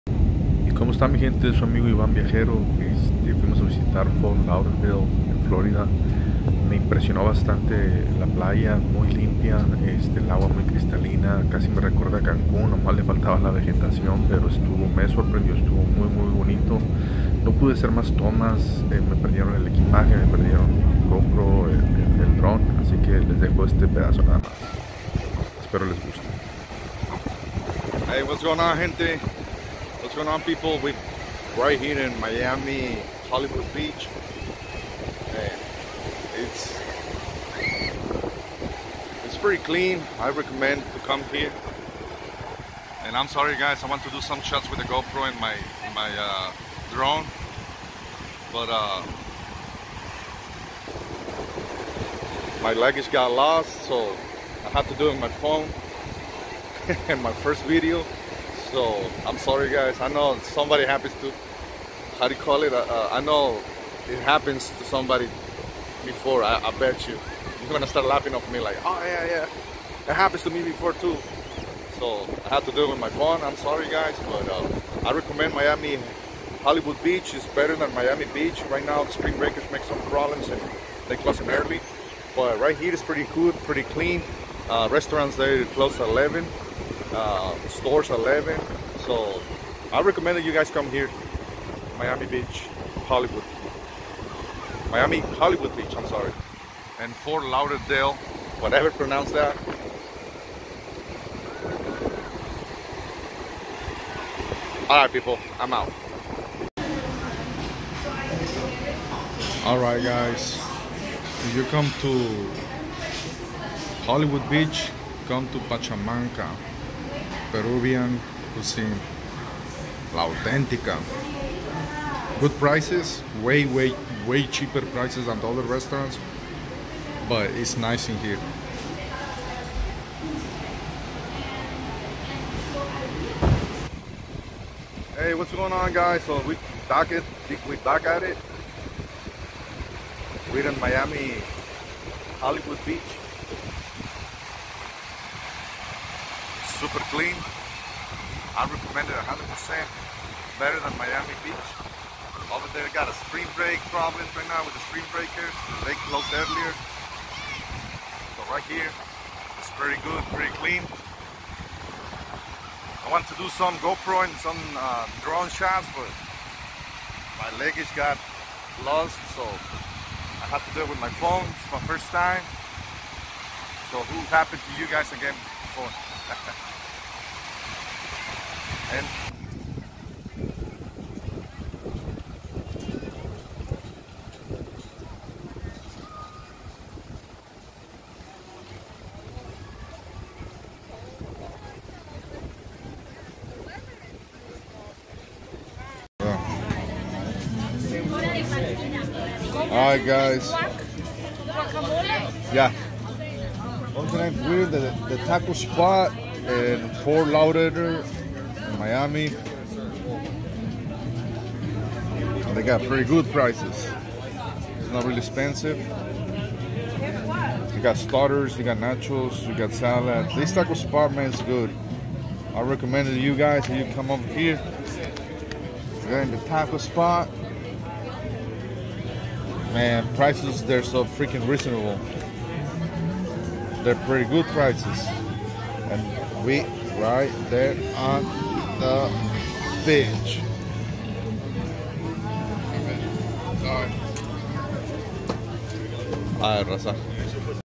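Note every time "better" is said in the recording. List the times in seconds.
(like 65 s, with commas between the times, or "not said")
77 s, 150 s.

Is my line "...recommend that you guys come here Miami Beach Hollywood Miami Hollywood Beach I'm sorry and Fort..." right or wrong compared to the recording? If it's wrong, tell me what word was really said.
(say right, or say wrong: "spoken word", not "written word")
right.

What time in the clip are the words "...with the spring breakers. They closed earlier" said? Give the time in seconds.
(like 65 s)
154 s.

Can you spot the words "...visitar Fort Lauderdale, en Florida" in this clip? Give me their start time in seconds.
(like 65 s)
3 s.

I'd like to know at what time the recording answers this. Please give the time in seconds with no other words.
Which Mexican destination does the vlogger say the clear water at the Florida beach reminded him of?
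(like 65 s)
12 s.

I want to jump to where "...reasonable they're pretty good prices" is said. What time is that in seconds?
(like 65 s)
231 s.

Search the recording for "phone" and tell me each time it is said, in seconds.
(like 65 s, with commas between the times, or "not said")
55 s, 73 s, 171 s.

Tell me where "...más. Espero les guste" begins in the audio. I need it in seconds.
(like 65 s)
24 s.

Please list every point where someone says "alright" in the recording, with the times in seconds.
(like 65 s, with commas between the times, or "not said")
104 s, 109 s.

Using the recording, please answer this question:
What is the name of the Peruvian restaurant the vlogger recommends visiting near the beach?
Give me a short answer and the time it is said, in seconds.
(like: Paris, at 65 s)
Pachamanca, at 115 s.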